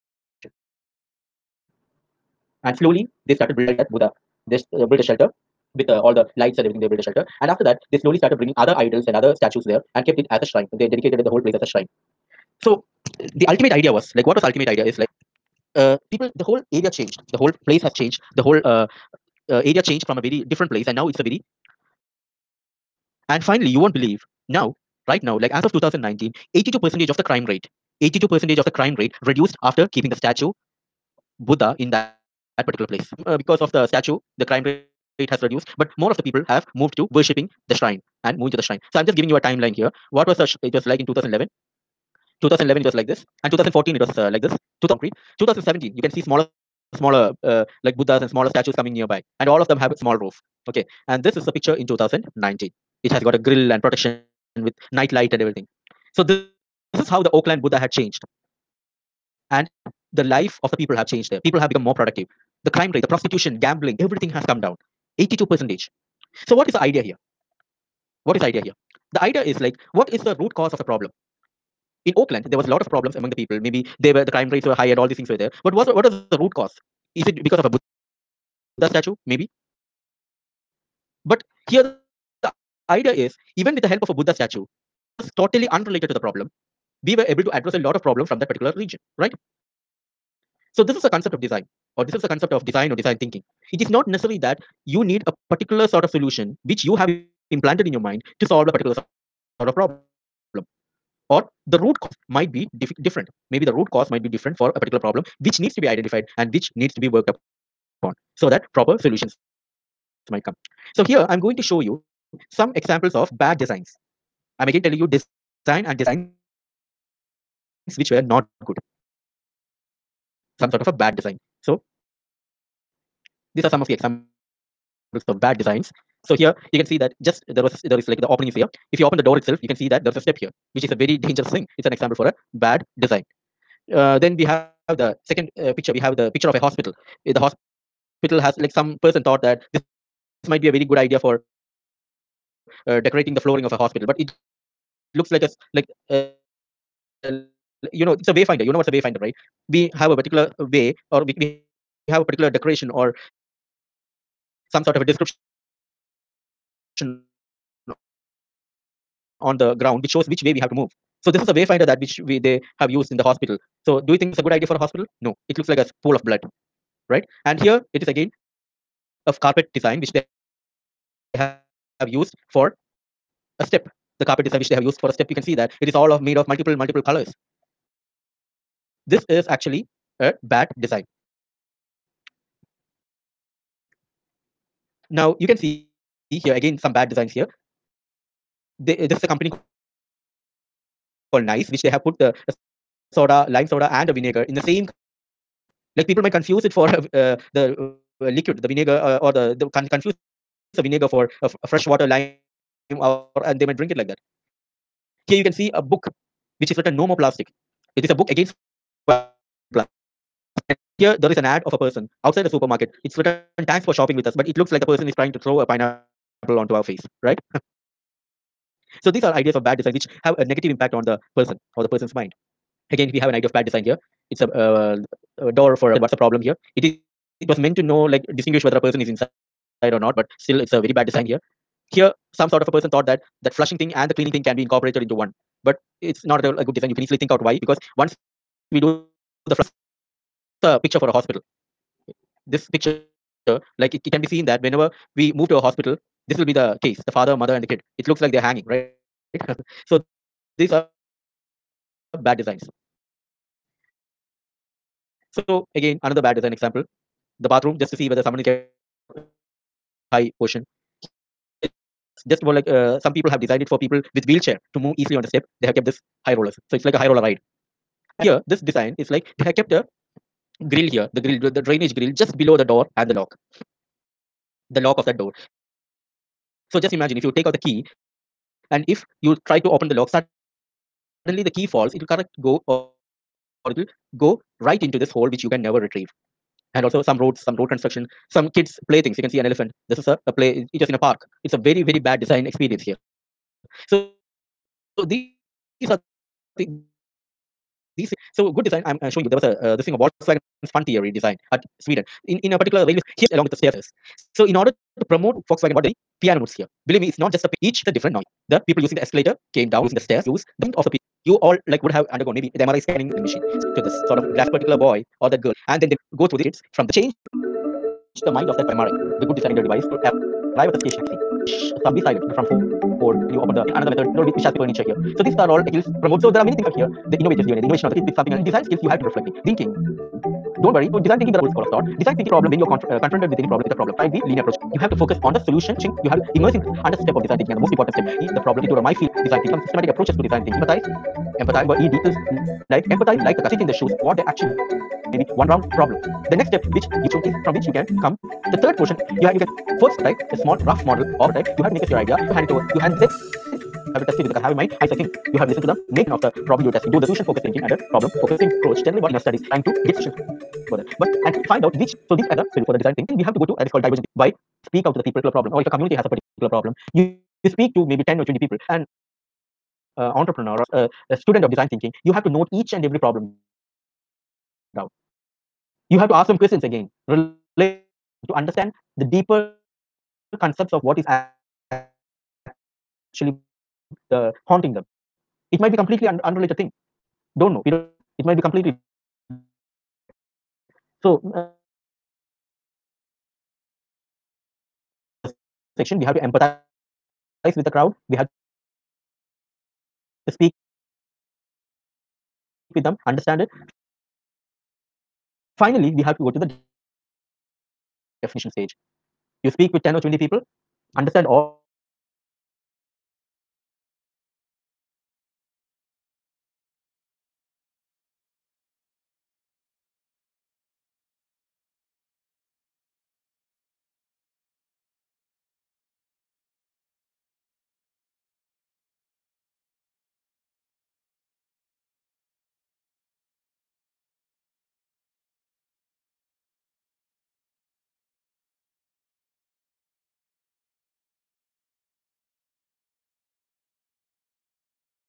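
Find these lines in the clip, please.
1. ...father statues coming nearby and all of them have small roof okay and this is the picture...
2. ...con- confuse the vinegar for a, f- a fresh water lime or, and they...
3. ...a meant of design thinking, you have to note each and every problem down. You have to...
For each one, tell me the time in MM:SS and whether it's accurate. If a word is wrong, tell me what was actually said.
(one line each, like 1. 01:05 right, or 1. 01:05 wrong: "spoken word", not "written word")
1. 00:48 wrong: "smaller", not "father"
2. 03:19 right
3. 06:11 wrong: "student", not "meant".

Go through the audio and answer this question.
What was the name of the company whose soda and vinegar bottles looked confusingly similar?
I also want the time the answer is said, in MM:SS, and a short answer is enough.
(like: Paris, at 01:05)
Nice, at 03:11.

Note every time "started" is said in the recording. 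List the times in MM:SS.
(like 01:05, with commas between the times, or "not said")
00:03, 00:08.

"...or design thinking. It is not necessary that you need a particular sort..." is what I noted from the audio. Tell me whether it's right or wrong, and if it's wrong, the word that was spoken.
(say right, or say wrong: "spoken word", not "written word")
right.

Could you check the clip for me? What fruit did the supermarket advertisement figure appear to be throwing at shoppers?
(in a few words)
pineapple.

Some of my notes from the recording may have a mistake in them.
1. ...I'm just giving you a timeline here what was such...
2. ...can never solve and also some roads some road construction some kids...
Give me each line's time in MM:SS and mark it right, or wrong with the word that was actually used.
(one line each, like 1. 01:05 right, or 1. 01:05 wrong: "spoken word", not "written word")
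1. 00:38 right
2. 04:45 wrong: "retrieve", not "solve".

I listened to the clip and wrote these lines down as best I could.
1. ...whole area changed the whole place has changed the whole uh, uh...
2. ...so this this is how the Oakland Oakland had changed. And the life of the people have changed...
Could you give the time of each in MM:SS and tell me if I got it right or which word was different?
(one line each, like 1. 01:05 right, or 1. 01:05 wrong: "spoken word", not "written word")
1. 00:16 right
2. 00:56 wrong: "Buddha", not "Oakland".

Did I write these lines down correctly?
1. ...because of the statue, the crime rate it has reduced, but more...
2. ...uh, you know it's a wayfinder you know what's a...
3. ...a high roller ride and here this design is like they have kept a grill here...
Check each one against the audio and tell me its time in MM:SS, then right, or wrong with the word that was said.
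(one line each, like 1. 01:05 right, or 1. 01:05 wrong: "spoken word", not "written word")
1. 00:33 right
2. 02:26 right
3. 04:26 right.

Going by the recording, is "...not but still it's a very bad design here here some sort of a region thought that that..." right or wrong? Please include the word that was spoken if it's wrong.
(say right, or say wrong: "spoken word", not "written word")
wrong: "person", not "region".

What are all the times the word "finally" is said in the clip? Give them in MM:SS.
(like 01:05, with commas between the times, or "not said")
00:23, 06:45.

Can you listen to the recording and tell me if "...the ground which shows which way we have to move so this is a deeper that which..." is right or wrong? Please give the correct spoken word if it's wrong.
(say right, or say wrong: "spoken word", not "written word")
wrong: "wayfinder", not "deeper".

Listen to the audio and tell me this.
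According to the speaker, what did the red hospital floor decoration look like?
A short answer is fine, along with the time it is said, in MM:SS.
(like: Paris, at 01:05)
a pool of blood, at 02:45.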